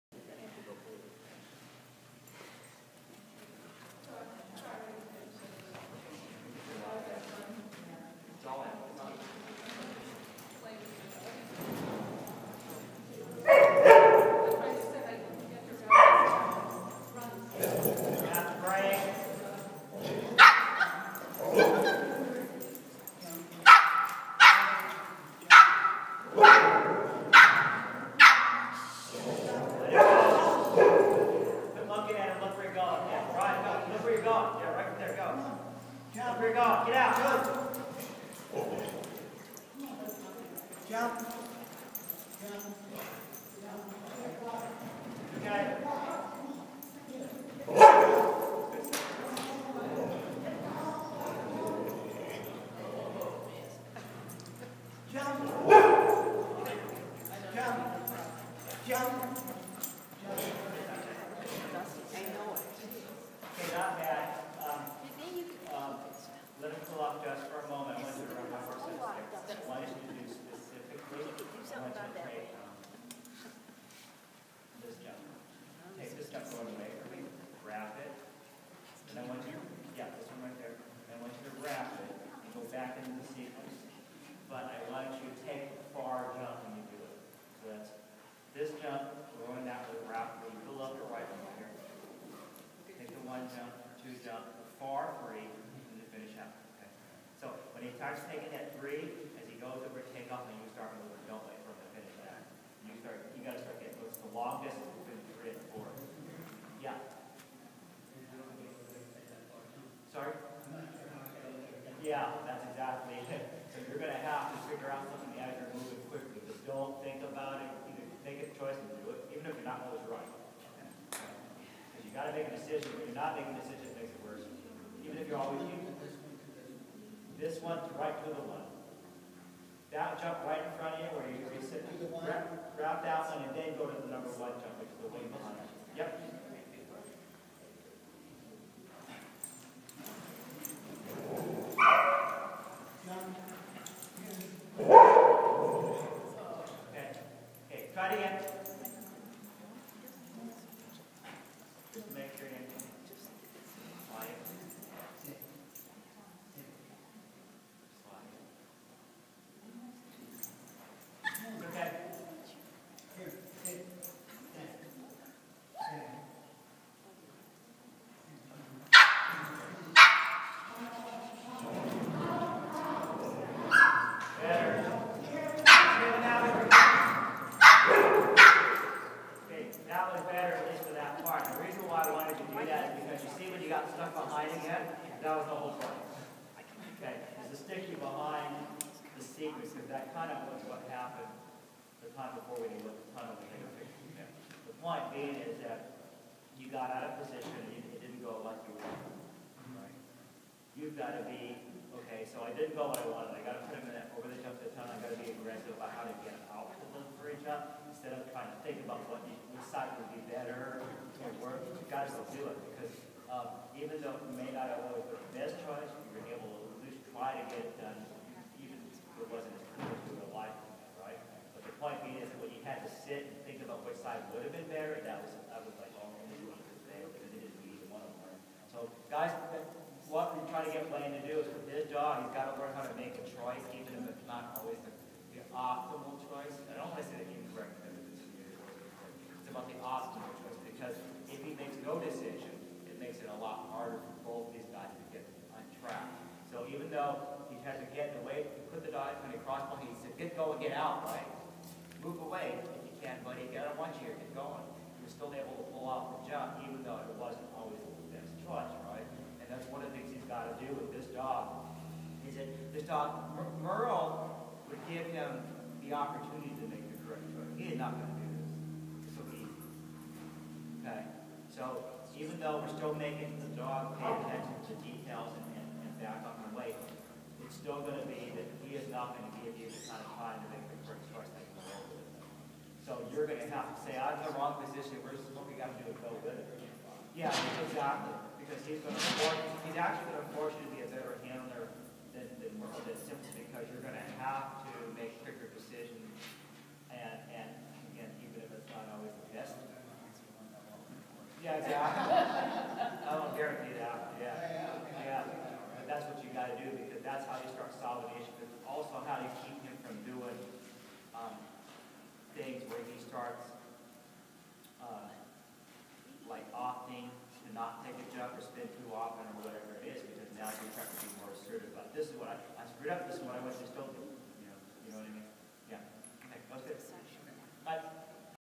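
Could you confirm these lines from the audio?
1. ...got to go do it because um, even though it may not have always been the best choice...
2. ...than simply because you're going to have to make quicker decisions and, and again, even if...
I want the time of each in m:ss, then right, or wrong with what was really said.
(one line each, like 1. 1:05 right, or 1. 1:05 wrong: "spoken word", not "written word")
1. 3:31 right
2. 4:52 right.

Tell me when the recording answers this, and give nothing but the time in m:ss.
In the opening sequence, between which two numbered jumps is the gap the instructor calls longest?
1:45.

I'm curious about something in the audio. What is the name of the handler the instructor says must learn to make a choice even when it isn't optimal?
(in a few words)
Blaine.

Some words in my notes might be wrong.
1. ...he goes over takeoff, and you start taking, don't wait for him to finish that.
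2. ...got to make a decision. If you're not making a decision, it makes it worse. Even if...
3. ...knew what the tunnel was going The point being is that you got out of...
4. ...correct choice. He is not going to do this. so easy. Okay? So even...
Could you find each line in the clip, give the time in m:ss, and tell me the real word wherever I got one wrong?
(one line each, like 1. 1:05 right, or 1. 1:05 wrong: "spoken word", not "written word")
1. 1:39 wrong: "moving", not "taking"
2. 2:02 right
3. 3:12 right
4. 4:27 right.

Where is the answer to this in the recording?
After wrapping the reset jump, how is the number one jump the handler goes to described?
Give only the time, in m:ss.
2:15.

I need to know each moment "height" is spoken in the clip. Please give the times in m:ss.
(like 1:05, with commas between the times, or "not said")
not said.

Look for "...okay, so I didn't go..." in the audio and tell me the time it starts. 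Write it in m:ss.
3:22.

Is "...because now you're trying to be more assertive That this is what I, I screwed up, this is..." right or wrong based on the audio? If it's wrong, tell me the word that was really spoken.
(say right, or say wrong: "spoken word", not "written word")
wrong: "But", not "That".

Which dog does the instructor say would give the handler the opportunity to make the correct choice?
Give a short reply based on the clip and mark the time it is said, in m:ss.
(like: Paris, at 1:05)
Merle, at 4:23.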